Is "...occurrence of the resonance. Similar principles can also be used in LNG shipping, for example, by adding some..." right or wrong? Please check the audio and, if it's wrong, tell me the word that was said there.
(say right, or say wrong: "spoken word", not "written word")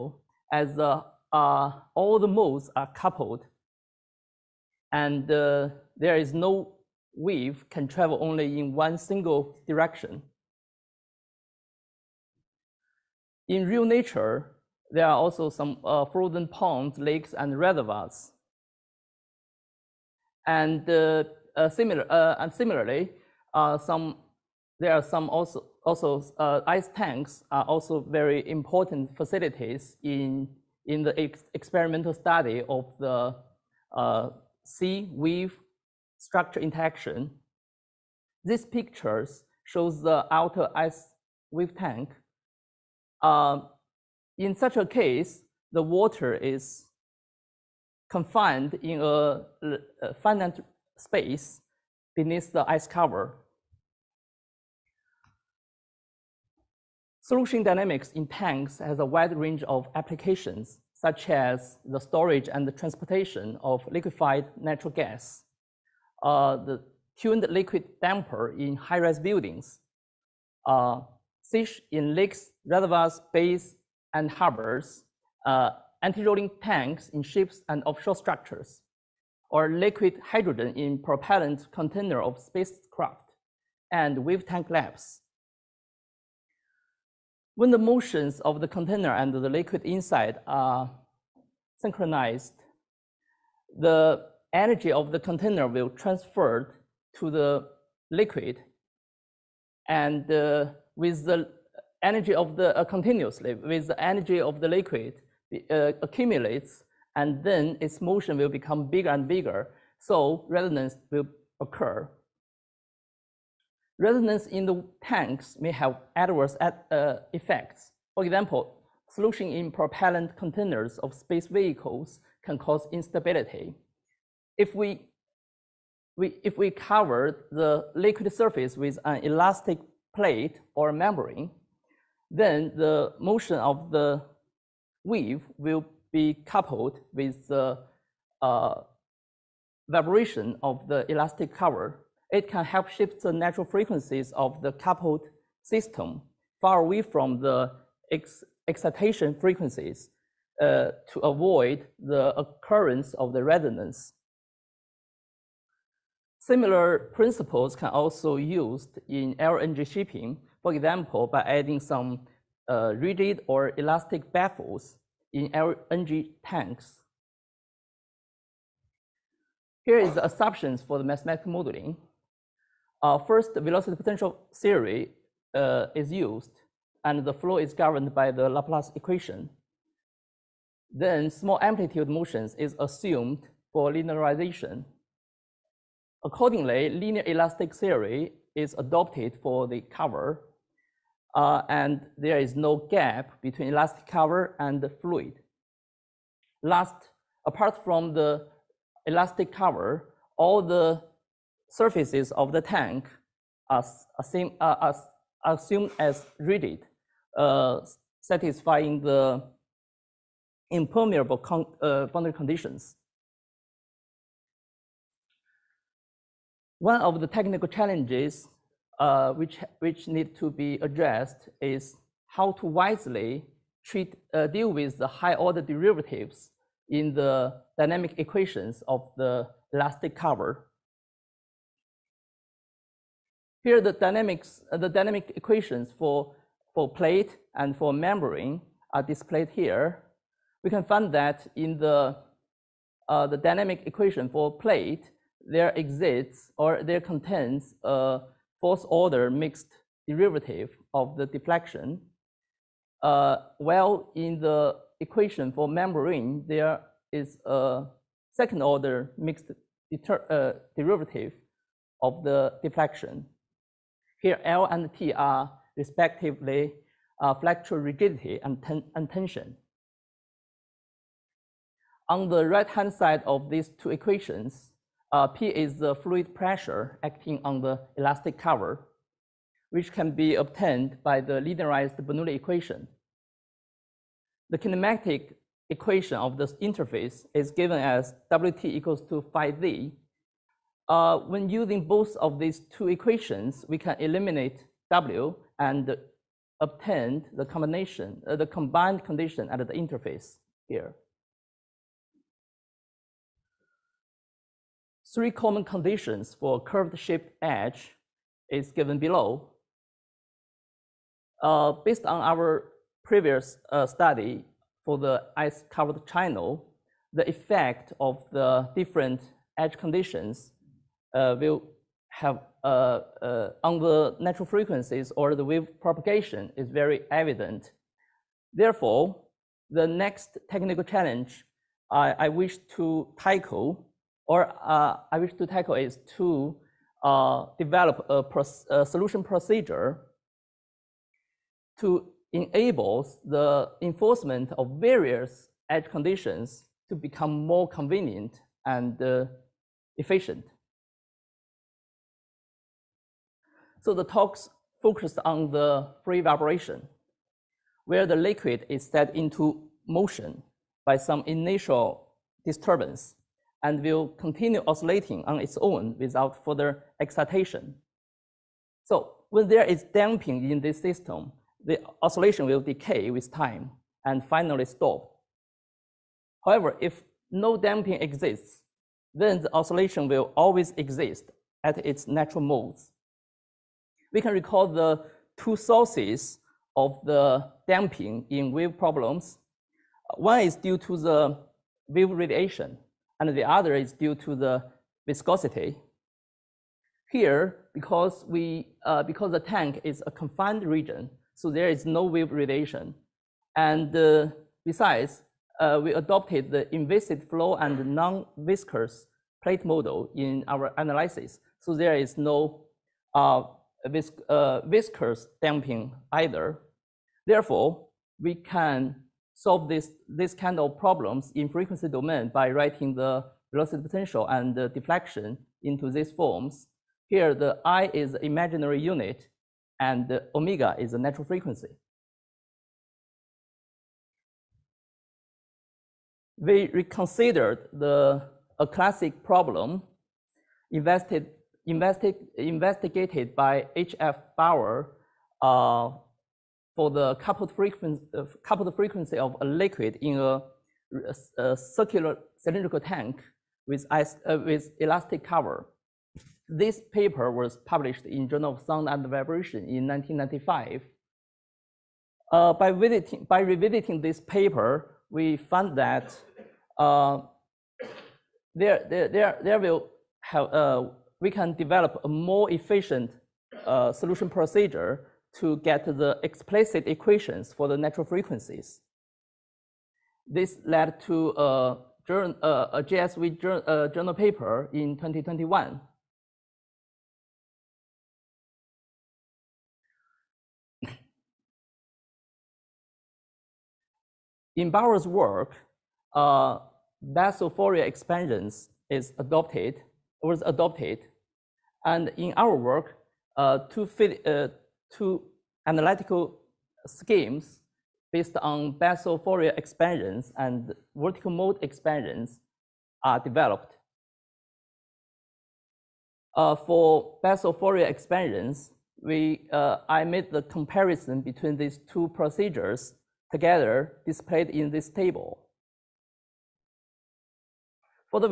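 right.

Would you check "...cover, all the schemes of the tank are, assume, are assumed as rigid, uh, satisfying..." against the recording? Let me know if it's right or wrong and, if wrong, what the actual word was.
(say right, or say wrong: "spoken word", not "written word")
wrong: "surfaces", not "schemes".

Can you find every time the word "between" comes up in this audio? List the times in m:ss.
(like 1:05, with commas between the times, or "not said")
3:13, 8:41.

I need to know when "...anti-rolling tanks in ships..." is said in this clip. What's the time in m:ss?
1:16.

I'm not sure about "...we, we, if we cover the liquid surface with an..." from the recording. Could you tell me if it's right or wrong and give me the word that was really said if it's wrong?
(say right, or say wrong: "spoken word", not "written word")
right.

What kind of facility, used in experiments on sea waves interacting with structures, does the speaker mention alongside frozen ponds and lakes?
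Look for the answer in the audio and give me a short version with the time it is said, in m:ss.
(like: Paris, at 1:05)
ice tanks, at 0:26.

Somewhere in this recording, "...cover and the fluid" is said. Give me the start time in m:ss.
3:14.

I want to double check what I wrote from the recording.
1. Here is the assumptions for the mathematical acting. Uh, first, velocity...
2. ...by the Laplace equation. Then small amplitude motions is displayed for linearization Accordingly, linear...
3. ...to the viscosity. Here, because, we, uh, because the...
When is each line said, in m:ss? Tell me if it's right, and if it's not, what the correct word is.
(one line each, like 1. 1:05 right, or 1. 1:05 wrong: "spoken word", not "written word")
1. 2:49 wrong: "modeling", not "acting"
2. 2:58 wrong: "assumed", not "displayed"
3. 6:34 right.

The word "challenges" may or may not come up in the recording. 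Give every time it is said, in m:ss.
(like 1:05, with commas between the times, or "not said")
3:37, 5:30.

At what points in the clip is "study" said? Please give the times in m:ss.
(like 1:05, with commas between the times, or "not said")
0:32, 5:13.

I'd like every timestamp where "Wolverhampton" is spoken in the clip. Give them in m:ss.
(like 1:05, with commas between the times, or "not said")
not said.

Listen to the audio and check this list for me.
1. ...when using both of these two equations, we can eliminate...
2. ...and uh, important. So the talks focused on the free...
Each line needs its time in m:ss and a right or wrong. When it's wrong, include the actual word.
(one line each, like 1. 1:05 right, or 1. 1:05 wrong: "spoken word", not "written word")
1. 4:51 right
2. 5:48 wrong: "efficient", not "important".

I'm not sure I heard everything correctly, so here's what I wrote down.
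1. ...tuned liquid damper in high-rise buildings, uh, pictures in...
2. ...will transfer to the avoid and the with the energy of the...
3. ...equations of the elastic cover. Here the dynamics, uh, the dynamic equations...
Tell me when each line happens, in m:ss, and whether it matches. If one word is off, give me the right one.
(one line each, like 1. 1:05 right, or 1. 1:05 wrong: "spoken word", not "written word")
1. 1:07 wrong: "seiches", not "pictures"
2. 1:35 wrong: "liquid", not "avoid"
3. 3:48 right.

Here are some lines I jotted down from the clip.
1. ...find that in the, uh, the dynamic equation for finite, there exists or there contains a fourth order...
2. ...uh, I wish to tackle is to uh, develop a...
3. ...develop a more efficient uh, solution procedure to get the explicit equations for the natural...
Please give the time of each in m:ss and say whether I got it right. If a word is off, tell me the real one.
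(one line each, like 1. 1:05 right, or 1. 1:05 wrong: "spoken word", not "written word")
1. 4:00 wrong: "plate", not "finite"
2. 5:34 right
3. 7:51 right.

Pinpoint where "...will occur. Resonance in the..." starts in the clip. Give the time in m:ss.
1:51.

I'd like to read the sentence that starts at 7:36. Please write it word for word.
This paper was published in Journal of Sound and Vibration in 1995.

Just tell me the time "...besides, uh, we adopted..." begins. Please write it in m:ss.
6:44.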